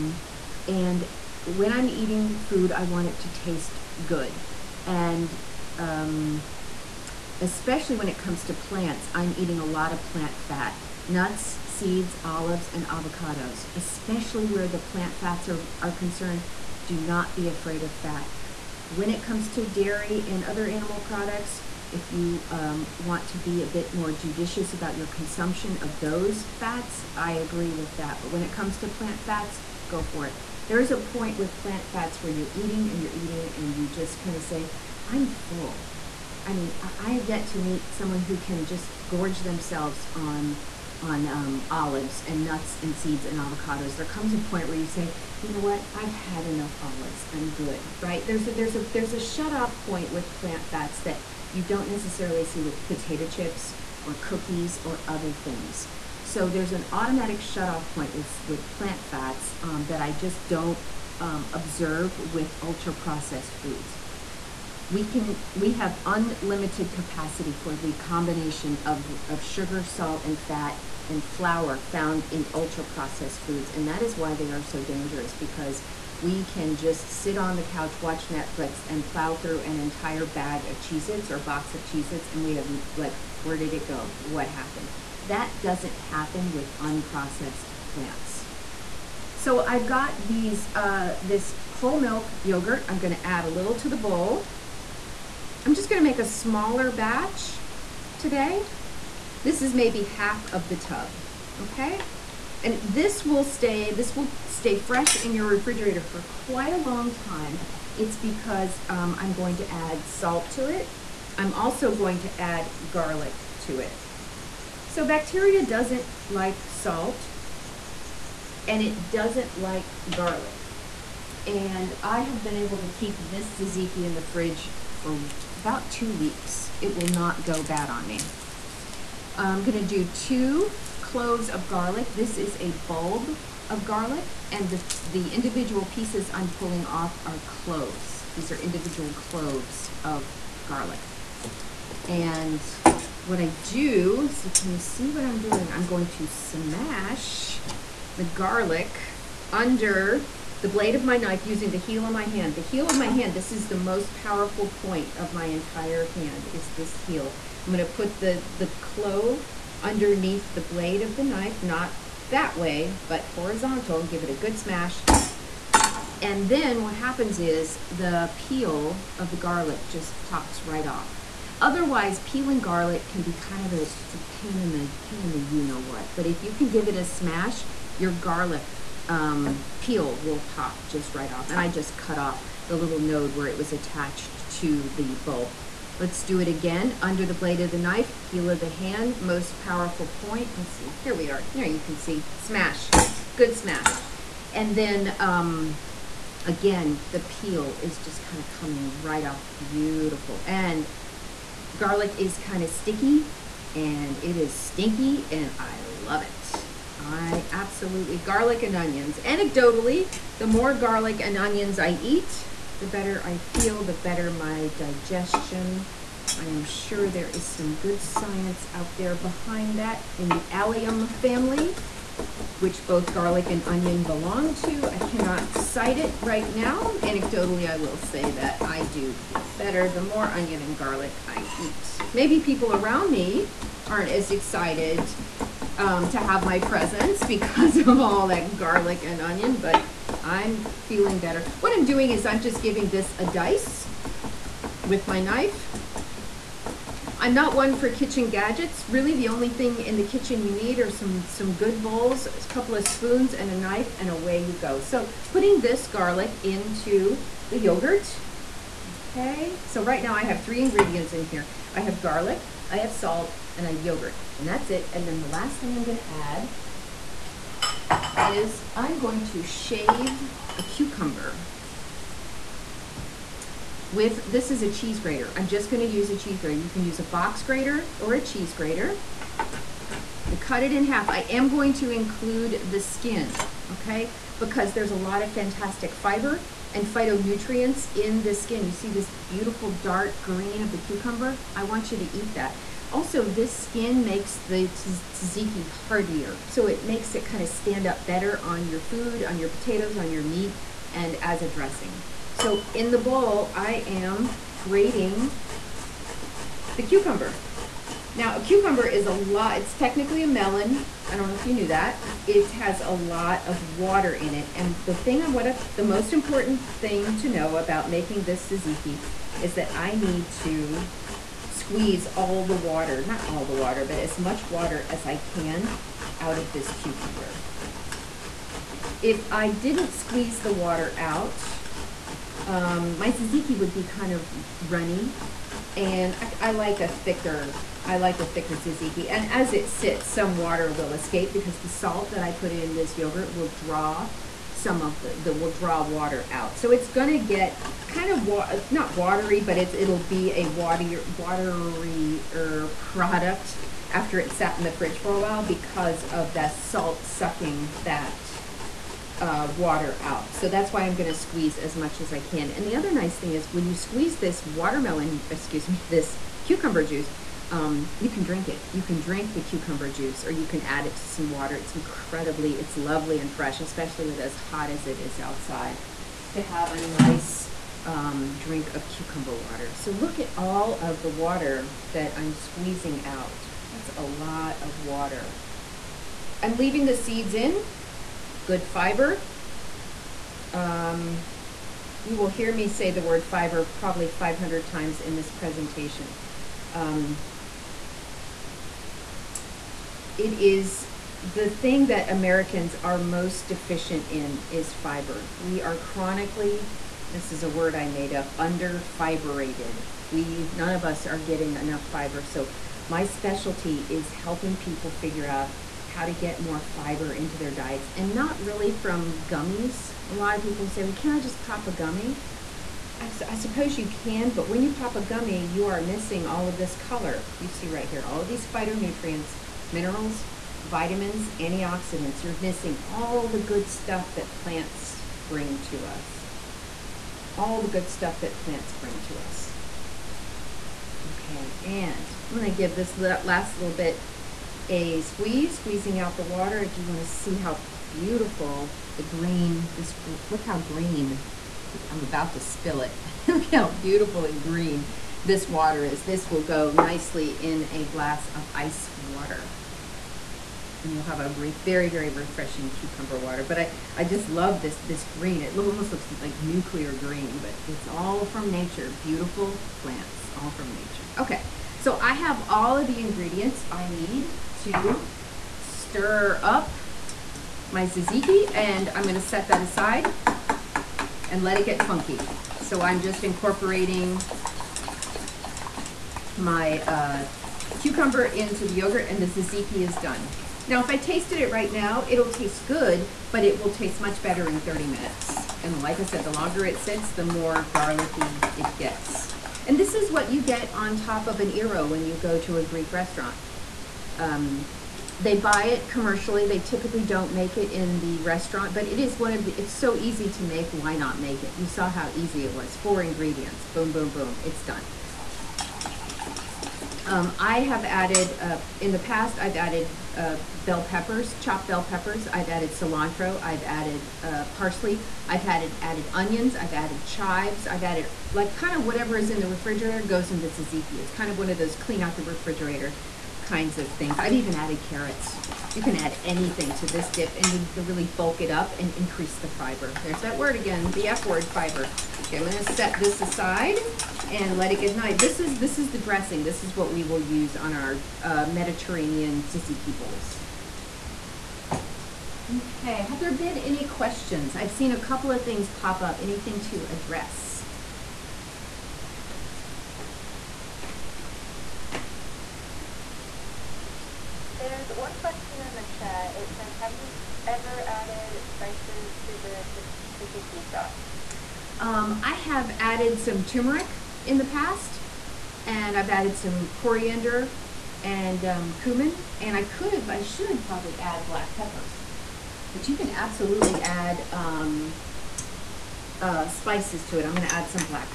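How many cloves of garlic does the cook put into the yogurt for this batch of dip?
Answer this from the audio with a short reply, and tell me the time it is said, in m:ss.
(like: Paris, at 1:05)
2, at 2:10.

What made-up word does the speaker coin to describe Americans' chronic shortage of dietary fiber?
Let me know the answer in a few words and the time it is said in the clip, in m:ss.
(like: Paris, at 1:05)
fiberated, at 6:48.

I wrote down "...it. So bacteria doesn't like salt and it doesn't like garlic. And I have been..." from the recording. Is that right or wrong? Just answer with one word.
right.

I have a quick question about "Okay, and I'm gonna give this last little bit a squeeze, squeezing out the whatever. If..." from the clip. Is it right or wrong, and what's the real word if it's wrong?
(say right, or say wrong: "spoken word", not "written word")
wrong: "water", not "whatever".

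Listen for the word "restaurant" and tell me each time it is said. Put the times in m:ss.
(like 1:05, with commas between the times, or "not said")
8:22, 8:28.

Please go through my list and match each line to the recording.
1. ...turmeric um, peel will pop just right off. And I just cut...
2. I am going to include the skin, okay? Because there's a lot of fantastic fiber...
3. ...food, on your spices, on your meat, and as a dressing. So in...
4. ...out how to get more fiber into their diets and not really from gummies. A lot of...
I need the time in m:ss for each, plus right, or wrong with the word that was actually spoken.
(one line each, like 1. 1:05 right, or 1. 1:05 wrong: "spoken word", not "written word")
1. 2:58 wrong: "garlic", not "turmeric"
2. 4:41 right
3. 4:58 wrong: "potatoes", not "spices"
4. 6:55 right.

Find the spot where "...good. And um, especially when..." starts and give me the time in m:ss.
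0:04.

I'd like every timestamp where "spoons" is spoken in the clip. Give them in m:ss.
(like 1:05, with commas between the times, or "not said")
4:12.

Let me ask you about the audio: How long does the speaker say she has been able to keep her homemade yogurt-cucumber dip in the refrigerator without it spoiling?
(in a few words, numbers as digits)
2 weeks.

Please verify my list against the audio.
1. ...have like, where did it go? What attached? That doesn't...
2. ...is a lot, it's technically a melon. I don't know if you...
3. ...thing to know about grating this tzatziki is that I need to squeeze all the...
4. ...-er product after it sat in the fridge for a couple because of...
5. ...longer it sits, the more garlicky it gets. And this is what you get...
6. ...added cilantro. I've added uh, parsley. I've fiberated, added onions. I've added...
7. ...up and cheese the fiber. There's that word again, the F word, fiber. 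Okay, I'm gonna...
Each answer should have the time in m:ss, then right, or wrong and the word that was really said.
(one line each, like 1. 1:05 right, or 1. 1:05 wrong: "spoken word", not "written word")
1. 1:22 wrong: "happened", not "attached"
2. 5:08 right
3. 5:16 wrong: "making", not "grating"
4. 5:52 wrong: "while", not "couple"
5. 8:16 right
6. 8:42 wrong: "added", not "fiberated"
7. 8:58 wrong: "increase", not "cheese".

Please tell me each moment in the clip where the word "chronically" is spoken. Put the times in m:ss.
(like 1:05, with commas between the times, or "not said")
6:45.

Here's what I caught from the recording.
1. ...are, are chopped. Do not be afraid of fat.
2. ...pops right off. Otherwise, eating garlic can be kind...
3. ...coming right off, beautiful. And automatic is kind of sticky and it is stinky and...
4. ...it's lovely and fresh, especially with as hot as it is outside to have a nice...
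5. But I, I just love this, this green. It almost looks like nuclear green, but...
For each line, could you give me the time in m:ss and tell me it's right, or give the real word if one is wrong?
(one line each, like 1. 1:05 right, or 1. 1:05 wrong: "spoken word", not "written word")
1. 0:15 wrong: "concerned", not "chopped"
2. 2:50 wrong: "peeling", not "eating"
3. 3:18 wrong: "garlic", not "automatic"
4. 6:12 right
5. 7:43 right.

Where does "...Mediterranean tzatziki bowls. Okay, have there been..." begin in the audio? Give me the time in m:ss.
9:08.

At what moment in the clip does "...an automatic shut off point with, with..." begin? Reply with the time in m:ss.
0:56.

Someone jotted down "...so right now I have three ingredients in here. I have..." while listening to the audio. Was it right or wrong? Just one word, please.
right.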